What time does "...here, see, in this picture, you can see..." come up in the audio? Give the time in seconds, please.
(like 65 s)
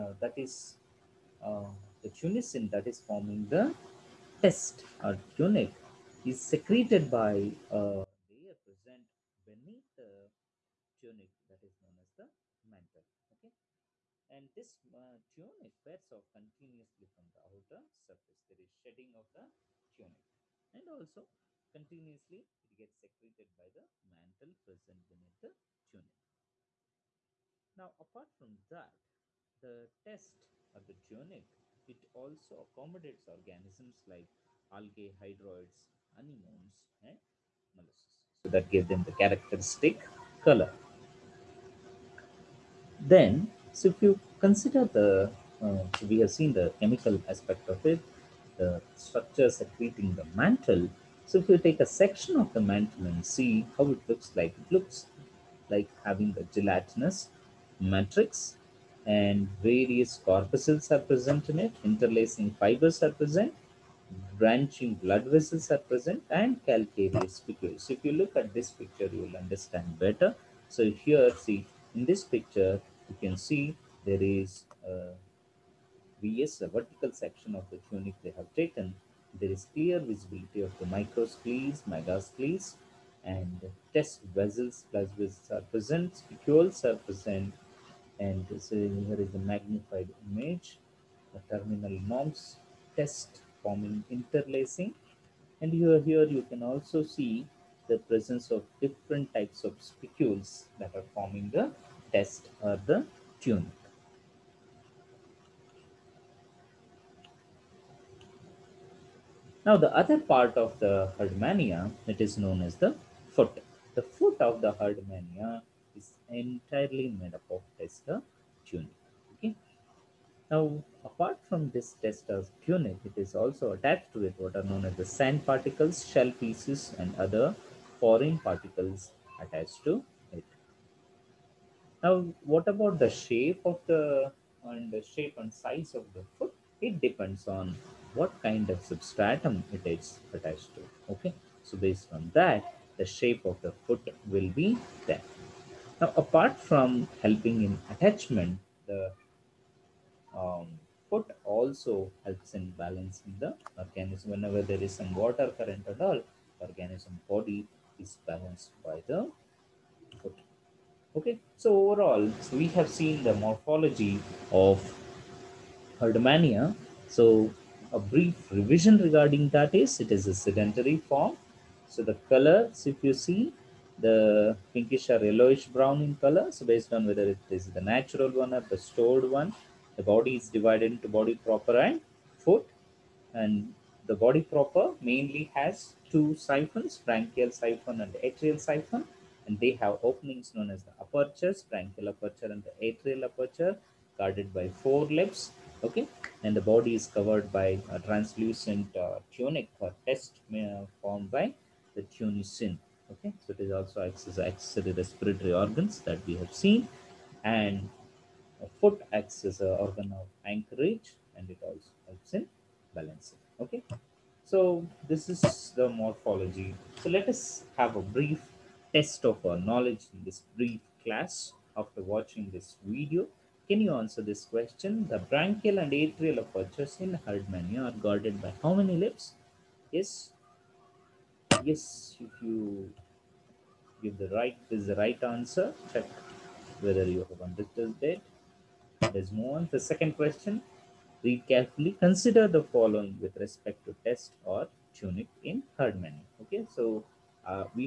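71 s.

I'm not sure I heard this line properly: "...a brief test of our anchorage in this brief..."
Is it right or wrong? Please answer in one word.
wrong.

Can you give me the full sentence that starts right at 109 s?
Now the other part of the Herdmania, it is known as the foot.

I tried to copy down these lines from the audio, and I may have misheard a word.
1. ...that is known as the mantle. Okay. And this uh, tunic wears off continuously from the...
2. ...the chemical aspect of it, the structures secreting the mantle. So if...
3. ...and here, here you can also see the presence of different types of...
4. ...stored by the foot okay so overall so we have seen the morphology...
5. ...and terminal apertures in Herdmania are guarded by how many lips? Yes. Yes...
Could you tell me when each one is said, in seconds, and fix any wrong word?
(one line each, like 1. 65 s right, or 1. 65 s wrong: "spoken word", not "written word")
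1. 11 s right
2. 46 s right
3. 95 s right
4. 158 s wrong: "balanced", not "stored"
5. 225 s wrong: "atrial", not "terminal".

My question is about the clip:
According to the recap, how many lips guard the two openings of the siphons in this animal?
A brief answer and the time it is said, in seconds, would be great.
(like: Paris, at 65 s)
4, at 194 s.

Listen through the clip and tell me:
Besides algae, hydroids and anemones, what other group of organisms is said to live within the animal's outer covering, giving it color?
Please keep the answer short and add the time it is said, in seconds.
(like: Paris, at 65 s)
Molluscs, at 37 s.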